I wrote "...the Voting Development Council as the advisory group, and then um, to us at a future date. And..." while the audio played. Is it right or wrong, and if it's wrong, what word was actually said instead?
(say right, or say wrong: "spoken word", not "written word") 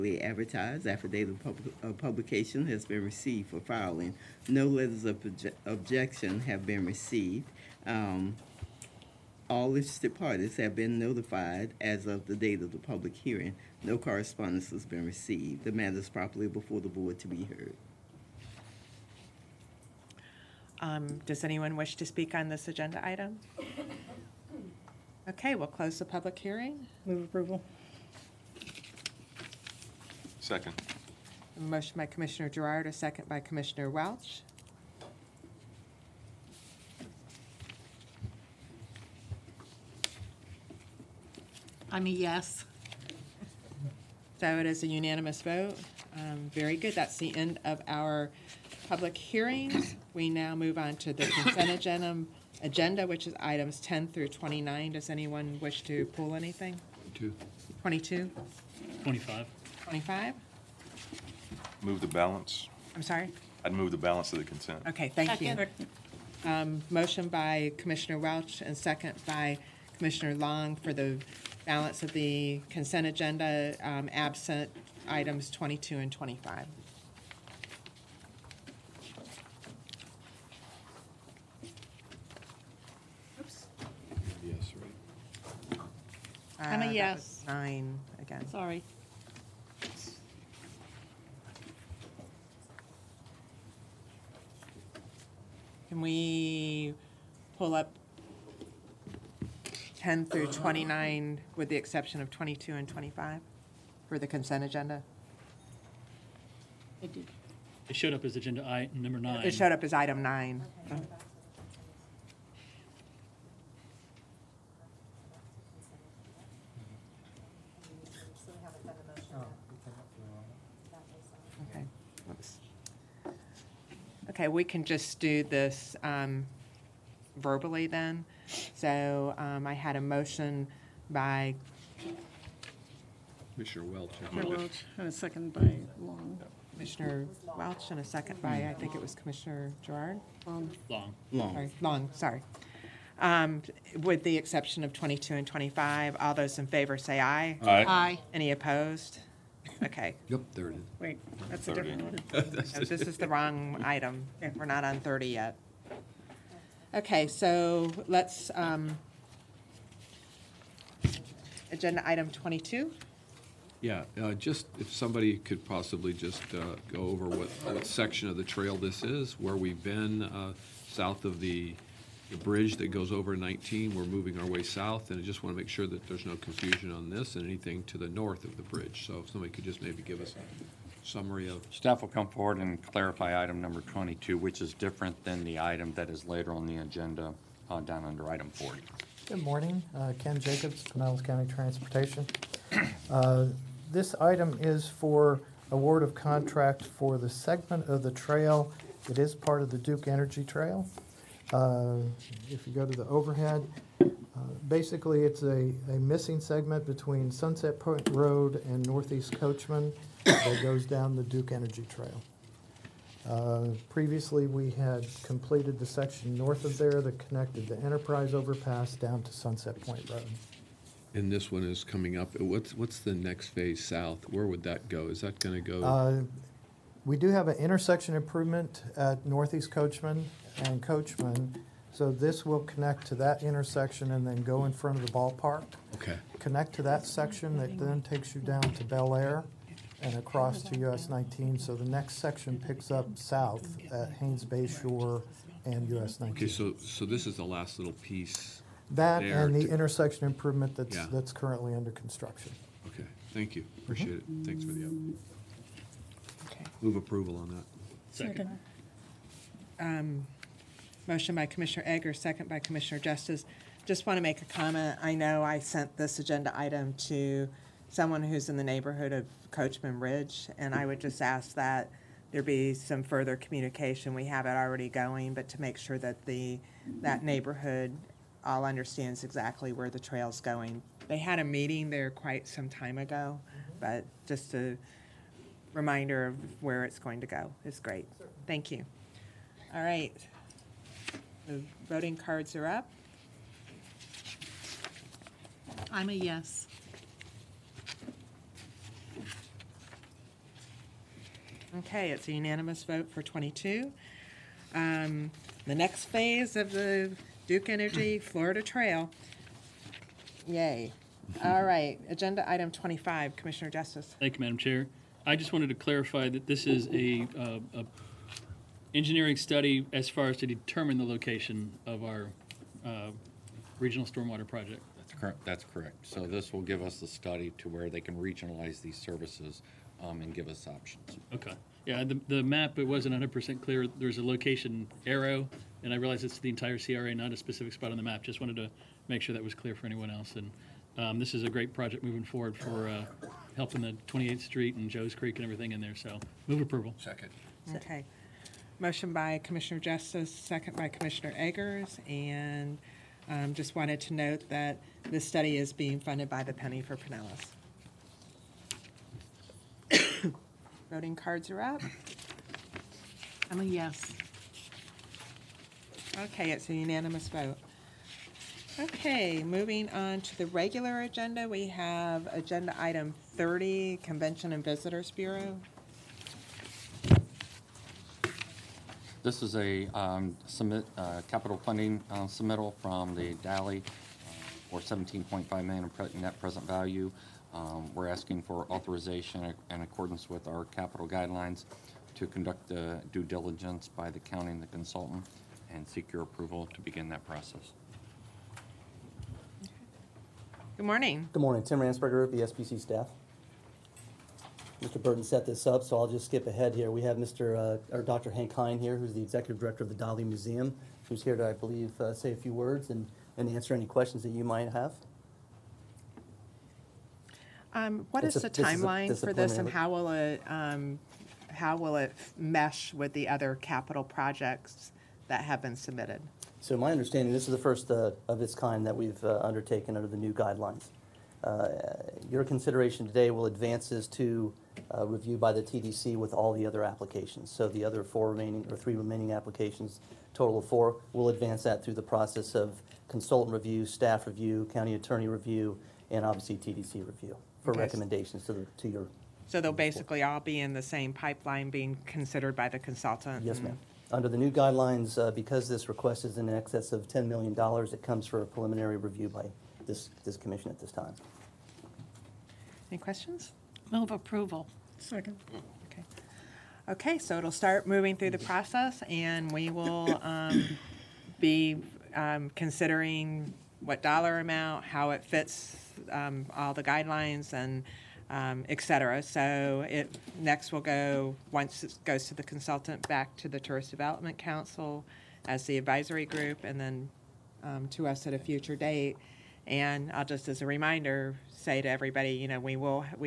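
wrong: "Tourist", not "Voting".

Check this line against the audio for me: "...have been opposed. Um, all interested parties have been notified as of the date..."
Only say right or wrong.
wrong.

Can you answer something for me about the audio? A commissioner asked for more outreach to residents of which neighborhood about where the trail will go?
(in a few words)
Coachman Ridge.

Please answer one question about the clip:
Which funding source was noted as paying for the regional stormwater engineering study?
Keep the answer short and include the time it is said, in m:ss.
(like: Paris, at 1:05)
Penny for Pinellas, at 5:56.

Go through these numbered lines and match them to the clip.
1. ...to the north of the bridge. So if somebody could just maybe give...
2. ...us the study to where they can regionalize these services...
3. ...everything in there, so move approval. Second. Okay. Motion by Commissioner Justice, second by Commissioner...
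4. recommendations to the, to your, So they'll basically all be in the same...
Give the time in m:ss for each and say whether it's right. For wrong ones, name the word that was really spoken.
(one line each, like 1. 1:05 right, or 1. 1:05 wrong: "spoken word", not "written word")
1. 2:57 right
2. 5:26 right
3. 5:45 right
4. 7:27 right.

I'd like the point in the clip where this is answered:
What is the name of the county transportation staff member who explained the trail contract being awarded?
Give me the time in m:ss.
3:10.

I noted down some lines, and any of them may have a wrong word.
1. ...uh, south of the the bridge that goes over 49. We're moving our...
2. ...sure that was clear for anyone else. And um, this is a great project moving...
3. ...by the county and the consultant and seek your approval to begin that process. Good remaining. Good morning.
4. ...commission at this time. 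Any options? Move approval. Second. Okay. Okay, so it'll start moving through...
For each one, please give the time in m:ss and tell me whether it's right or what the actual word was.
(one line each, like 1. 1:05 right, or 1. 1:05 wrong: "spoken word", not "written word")
1. 2:50 wrong: "19", not "49"
2. 5:39 right
3. 6:33 wrong: "morning", not "remaining"
4. 7:40 wrong: "questions", not "options".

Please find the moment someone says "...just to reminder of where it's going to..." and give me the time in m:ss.
4:44.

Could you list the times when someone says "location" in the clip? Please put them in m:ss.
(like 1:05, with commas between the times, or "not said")
5:21, 5:34.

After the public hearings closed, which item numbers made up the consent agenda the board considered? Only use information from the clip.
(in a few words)
10 through 29.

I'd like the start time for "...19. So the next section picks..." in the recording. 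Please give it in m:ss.
4:01.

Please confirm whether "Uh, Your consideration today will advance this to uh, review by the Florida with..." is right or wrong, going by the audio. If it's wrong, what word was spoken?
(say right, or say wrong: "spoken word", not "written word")
wrong: "TDC", not "Florida".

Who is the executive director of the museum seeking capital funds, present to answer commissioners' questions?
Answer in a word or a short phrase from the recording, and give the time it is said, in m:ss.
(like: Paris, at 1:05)
Hank Hine, at 6:48.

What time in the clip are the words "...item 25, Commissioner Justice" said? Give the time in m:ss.
5:12.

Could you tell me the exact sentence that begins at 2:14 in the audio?
By Welch, and a second by Long.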